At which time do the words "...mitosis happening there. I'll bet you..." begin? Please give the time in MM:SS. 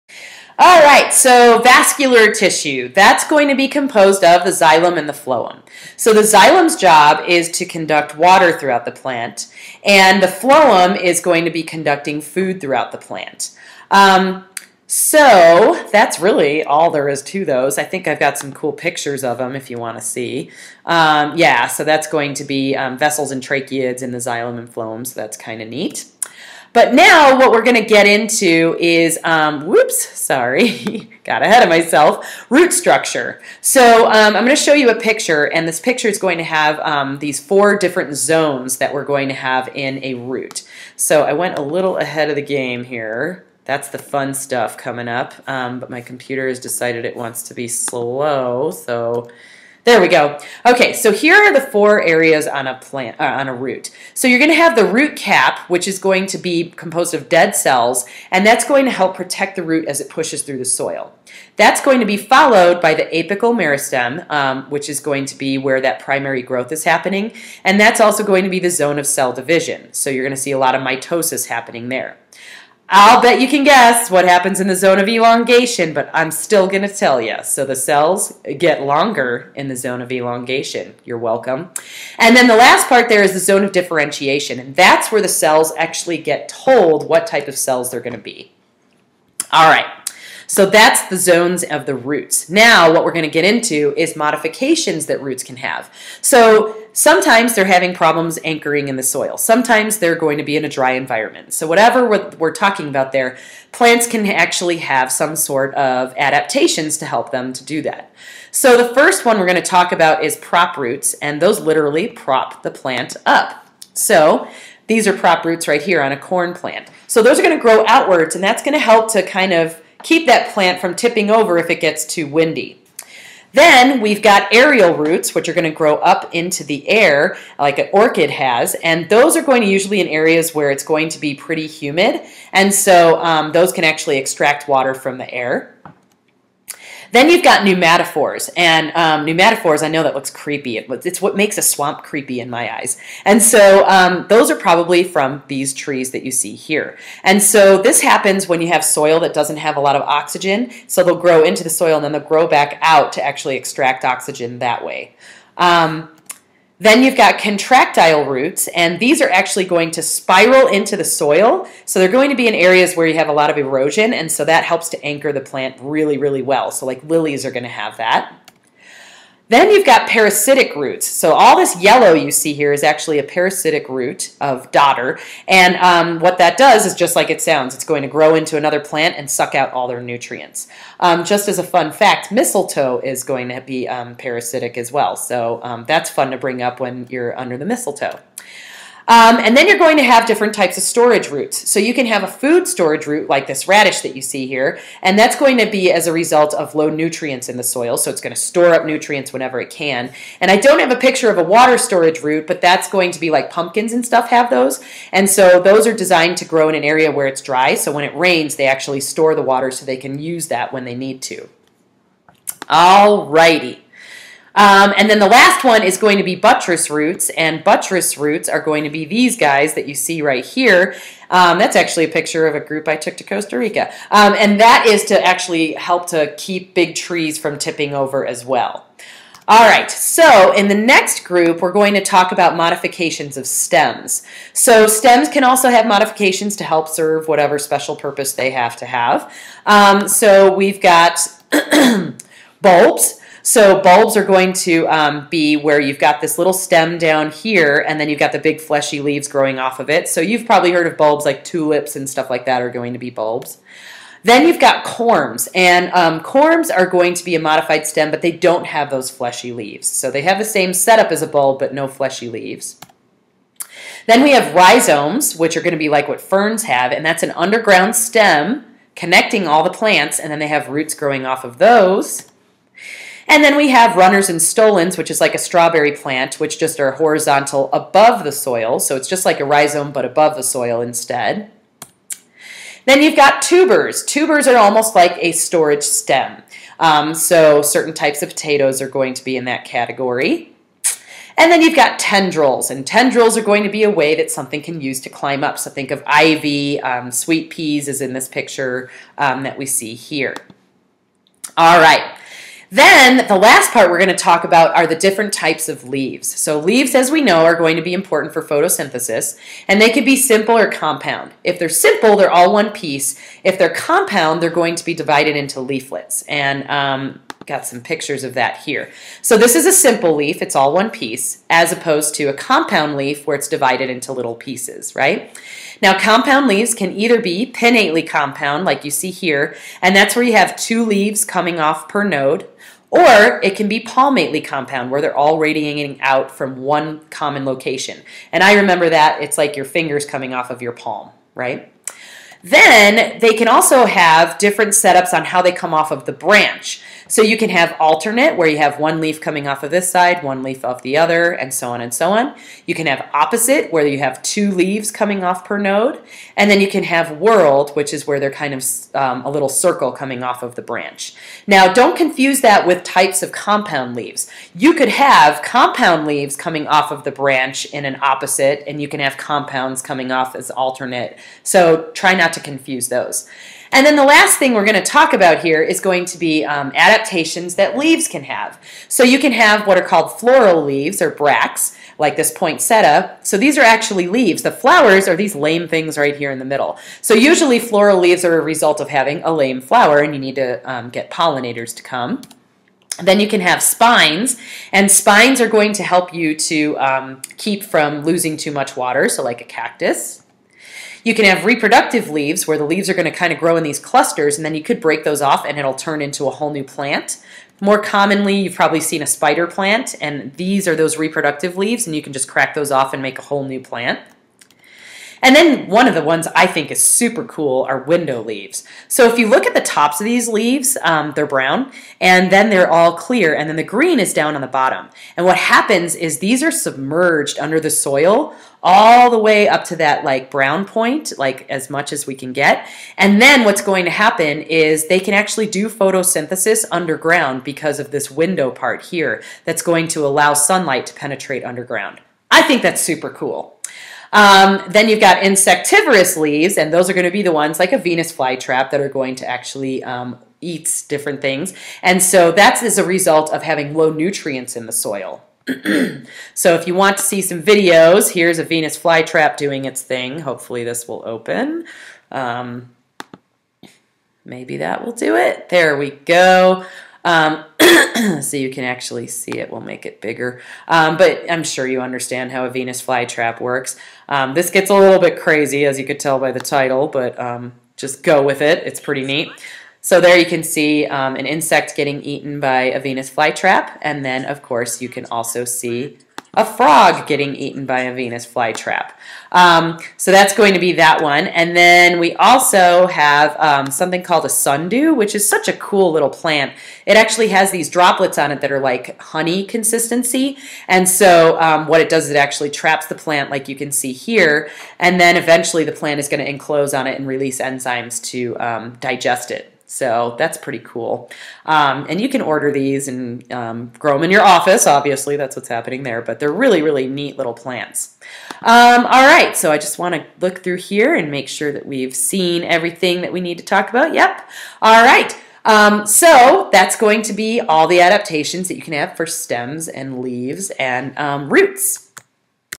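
01:10.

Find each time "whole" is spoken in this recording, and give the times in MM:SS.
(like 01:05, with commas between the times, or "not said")
06:46, 06:53.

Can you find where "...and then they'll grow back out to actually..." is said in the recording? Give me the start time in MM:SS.
02:31.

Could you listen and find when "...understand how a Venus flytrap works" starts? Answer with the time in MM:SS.
07:51.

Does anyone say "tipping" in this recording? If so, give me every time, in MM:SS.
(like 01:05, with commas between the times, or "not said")
02:00, 03:47.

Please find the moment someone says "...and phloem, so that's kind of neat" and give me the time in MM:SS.
00:24.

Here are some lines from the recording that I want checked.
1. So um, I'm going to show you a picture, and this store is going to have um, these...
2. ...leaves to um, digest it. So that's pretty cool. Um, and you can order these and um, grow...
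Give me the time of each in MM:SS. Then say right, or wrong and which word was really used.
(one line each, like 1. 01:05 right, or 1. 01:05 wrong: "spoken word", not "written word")
1. 00:33 wrong: "picture", not "store"
2. 08:27 wrong: "enzymes", not "leaves".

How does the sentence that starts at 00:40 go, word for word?
So I went a little ahead of the game here.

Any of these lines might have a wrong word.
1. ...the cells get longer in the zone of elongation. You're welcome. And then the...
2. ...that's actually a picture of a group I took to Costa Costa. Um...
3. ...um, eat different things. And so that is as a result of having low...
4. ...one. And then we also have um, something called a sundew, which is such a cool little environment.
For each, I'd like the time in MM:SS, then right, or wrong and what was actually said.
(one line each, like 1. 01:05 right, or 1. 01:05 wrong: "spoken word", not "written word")
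1. 01:17 right
2. 03:41 wrong: "Rica", not "Costa"
3. 07:29 right
4. 08:11 wrong: "plant", not "environment".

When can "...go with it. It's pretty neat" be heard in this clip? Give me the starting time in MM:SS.
07:58.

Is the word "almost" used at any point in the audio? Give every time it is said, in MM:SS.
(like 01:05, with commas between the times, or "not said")
04:44.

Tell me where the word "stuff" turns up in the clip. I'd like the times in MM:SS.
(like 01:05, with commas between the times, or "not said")
00:44, 03:24, 04:12.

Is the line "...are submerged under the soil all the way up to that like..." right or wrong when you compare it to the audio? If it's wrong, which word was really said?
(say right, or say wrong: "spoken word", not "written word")
right.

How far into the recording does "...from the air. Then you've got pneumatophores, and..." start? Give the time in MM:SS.
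02:14.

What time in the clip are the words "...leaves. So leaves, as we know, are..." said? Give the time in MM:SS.
05:05.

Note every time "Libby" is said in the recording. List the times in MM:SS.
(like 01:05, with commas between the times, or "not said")
not said.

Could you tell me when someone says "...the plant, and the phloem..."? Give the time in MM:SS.
00:08.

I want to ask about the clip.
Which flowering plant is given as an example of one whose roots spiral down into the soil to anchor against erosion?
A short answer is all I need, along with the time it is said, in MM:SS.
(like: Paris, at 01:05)
lilies, at 02:47.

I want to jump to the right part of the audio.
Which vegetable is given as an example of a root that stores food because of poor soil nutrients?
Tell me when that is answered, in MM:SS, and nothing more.
03:13.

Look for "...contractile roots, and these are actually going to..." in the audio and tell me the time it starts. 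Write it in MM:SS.
02:37.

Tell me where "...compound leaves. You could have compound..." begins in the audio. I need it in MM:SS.
06:03.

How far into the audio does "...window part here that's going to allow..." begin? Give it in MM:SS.
07:18.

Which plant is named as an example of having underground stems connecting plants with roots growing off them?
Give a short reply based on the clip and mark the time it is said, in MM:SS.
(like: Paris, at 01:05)
ferns, at 04:26.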